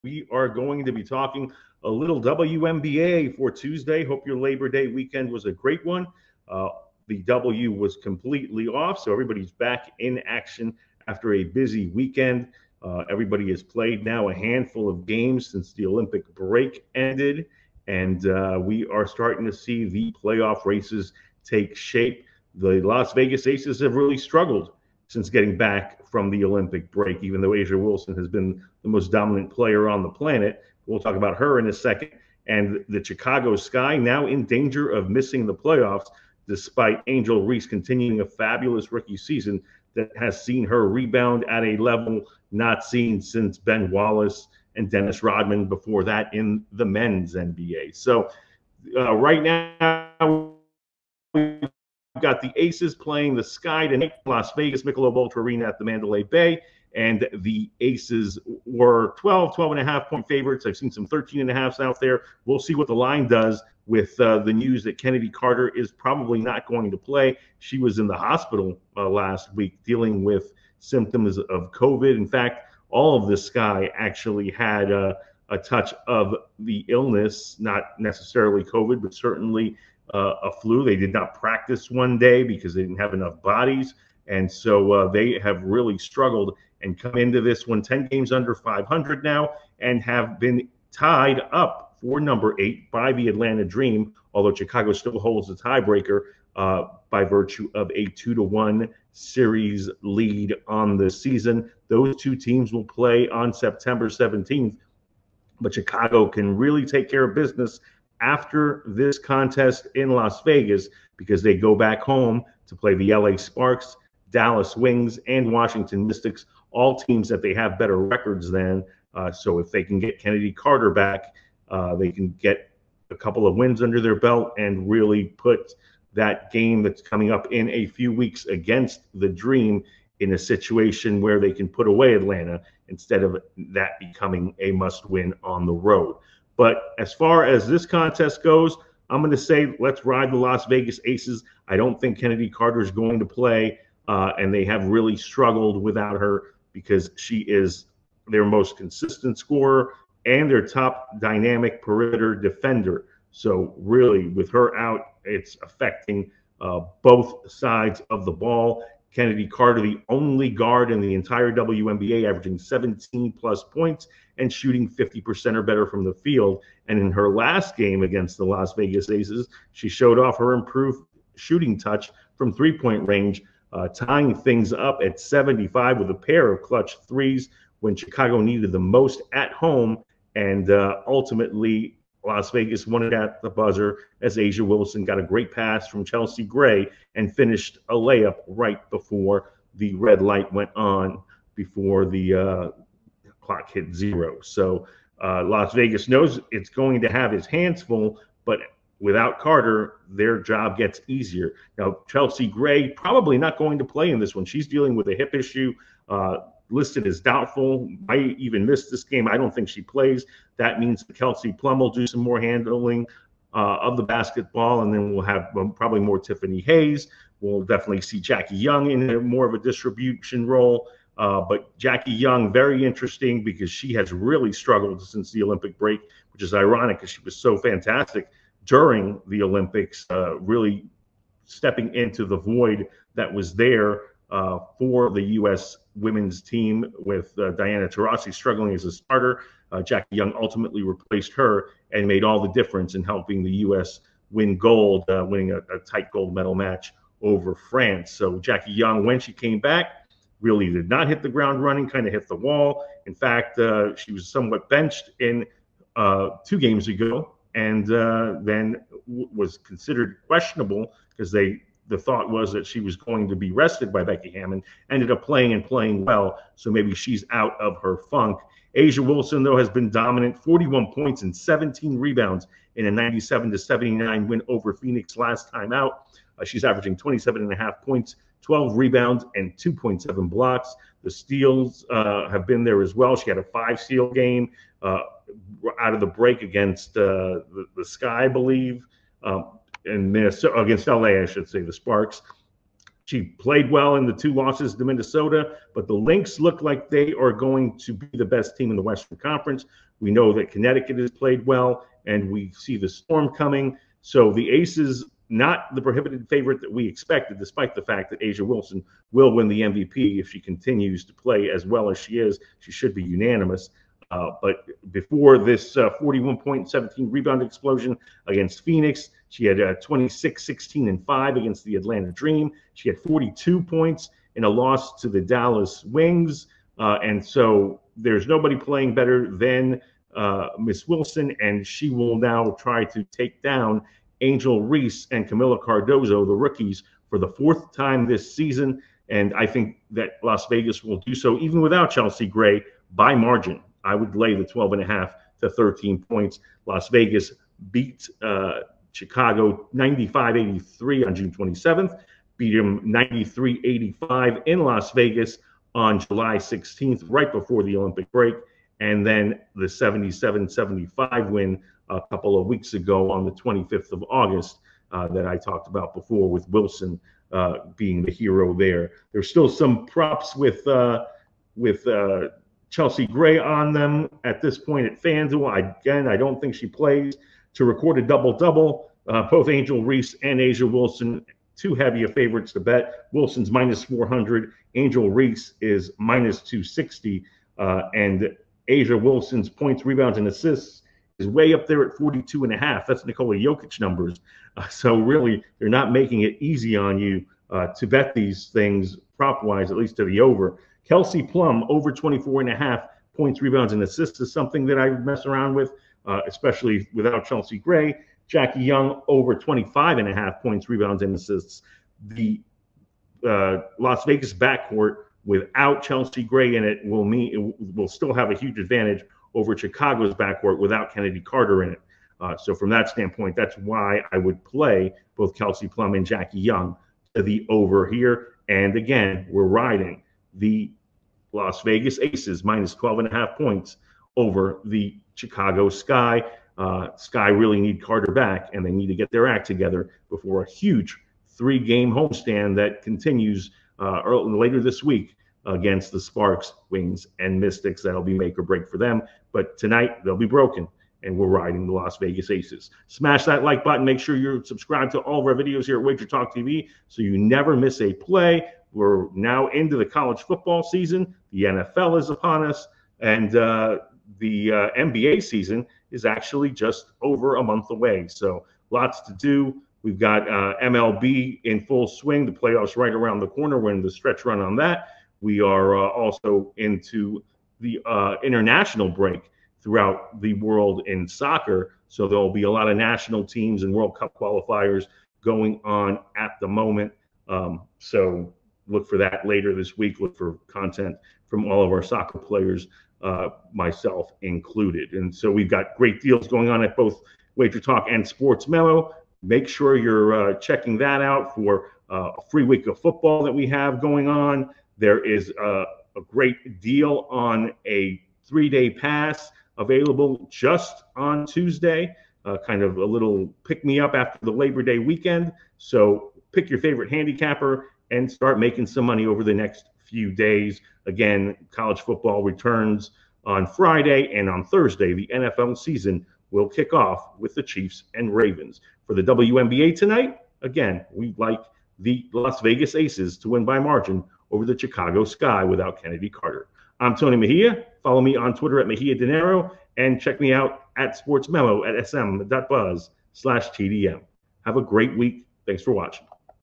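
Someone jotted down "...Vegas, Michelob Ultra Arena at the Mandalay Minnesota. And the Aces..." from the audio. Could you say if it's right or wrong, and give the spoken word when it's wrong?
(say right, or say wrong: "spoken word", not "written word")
wrong: "Bay", not "Minnesota".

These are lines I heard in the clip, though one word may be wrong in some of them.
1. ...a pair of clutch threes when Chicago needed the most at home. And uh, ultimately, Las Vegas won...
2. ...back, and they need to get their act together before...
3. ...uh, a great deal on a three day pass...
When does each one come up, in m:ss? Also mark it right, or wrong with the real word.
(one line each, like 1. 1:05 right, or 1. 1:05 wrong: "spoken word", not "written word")
1. 2:56 right
2. 7:18 right
3. 8:25 right.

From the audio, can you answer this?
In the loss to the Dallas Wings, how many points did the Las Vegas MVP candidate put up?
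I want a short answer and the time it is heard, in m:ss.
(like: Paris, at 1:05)
42, at 5:22.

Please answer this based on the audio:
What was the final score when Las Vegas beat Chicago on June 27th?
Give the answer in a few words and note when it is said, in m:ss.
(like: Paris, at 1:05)
95-83, at 5:49.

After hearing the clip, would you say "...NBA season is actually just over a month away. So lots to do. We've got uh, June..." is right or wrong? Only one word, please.
wrong.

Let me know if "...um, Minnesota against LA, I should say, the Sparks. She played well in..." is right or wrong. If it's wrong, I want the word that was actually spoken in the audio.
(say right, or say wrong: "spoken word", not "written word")
right.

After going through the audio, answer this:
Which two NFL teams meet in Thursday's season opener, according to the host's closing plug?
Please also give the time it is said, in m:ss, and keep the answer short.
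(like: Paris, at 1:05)
Chiefs and Ravens, at 8:47.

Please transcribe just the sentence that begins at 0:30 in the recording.
We'll talk about her in a second.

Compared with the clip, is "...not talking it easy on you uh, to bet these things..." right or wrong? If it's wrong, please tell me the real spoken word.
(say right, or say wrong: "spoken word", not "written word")
wrong: "making", not "talking".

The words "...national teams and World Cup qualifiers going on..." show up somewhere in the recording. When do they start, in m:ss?
8:02.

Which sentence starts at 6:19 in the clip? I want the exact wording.
Uh, both Angel Reese and A'ja Wilson, too heavy of favorites to bet.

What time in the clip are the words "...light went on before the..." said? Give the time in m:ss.
3:10.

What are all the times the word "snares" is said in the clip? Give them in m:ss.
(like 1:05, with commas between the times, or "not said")
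not said.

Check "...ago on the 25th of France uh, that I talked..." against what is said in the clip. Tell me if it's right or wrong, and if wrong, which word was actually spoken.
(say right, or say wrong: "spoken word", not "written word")
wrong: "August", not "France".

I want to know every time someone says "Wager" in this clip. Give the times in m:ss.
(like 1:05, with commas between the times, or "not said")
7:35, 8:17.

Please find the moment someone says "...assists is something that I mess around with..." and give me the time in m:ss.
6:43.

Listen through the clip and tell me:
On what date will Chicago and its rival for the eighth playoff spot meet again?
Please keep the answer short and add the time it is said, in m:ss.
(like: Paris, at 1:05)
September 17th, at 1:43.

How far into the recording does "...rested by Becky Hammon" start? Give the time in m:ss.
4:23.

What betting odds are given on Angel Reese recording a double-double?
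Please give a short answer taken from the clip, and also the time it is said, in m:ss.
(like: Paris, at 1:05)
-260, at 6:25.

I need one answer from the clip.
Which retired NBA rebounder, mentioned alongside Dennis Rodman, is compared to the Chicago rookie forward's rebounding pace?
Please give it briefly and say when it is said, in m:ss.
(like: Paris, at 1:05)
Ben Wallace, at 0:43.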